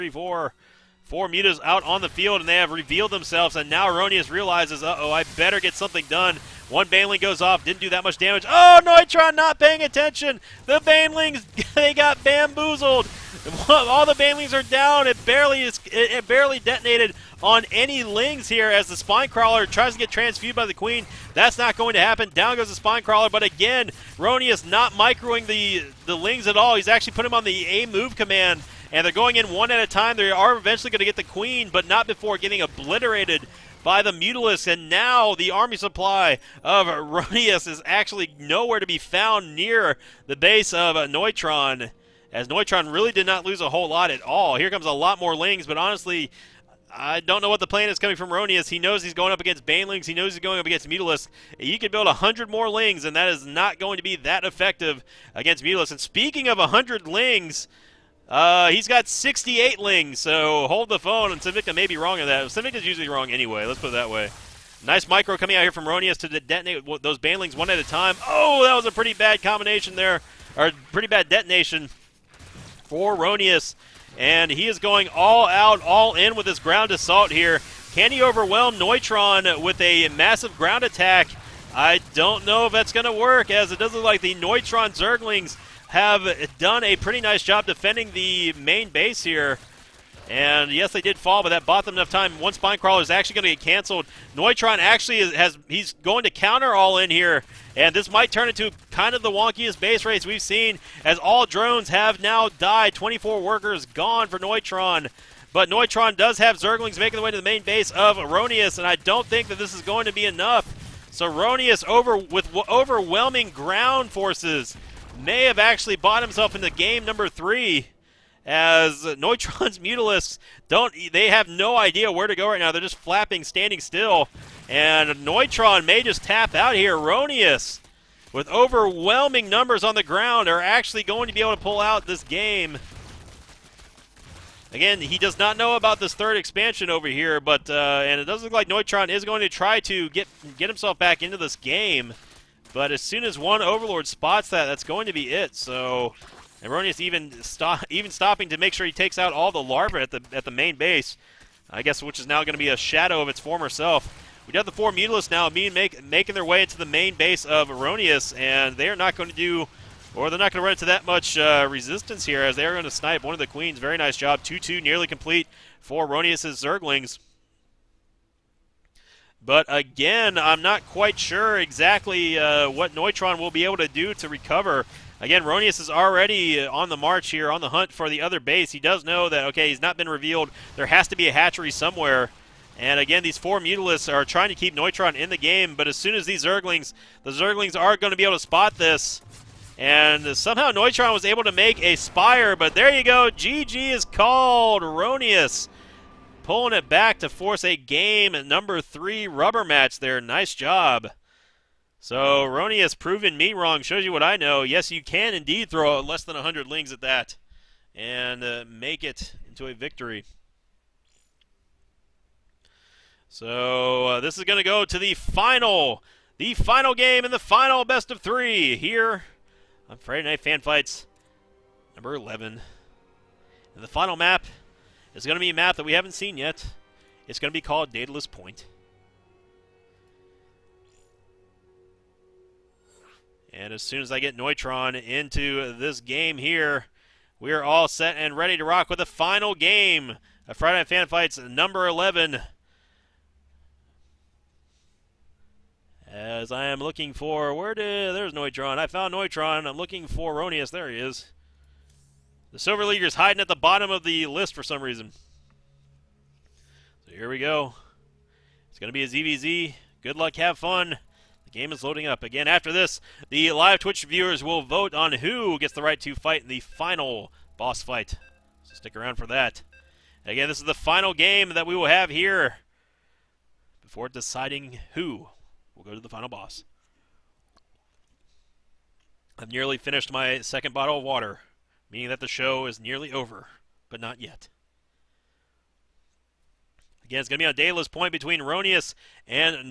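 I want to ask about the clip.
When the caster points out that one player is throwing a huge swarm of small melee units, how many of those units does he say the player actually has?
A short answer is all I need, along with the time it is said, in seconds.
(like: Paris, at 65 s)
68, at 59 s.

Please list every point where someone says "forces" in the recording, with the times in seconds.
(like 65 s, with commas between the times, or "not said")
114 s, 197 s.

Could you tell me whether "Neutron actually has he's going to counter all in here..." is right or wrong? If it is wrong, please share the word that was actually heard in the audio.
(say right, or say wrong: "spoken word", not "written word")
right.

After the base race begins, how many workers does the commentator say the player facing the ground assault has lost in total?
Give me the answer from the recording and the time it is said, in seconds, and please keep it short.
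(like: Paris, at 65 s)
24, at 102 s.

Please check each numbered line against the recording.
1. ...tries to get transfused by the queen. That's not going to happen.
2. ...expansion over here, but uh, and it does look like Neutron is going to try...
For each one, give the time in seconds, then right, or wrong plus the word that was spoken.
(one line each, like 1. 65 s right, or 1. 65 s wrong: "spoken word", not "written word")
1. 19 s right
2. 136 s right.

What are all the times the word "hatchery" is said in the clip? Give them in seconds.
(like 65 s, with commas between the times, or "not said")
181 s.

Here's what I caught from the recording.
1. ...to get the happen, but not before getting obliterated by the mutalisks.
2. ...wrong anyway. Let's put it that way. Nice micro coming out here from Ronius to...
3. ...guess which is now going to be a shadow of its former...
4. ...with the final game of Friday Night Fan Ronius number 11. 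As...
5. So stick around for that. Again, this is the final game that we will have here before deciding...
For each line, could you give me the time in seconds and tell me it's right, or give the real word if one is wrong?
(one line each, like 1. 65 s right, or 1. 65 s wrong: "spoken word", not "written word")
1. 30 s wrong: "queen", not "happen"
2. 63 s right
3. 151 s right
4. 238 s wrong: "Fights", not "Ronius"
5. 268 s right.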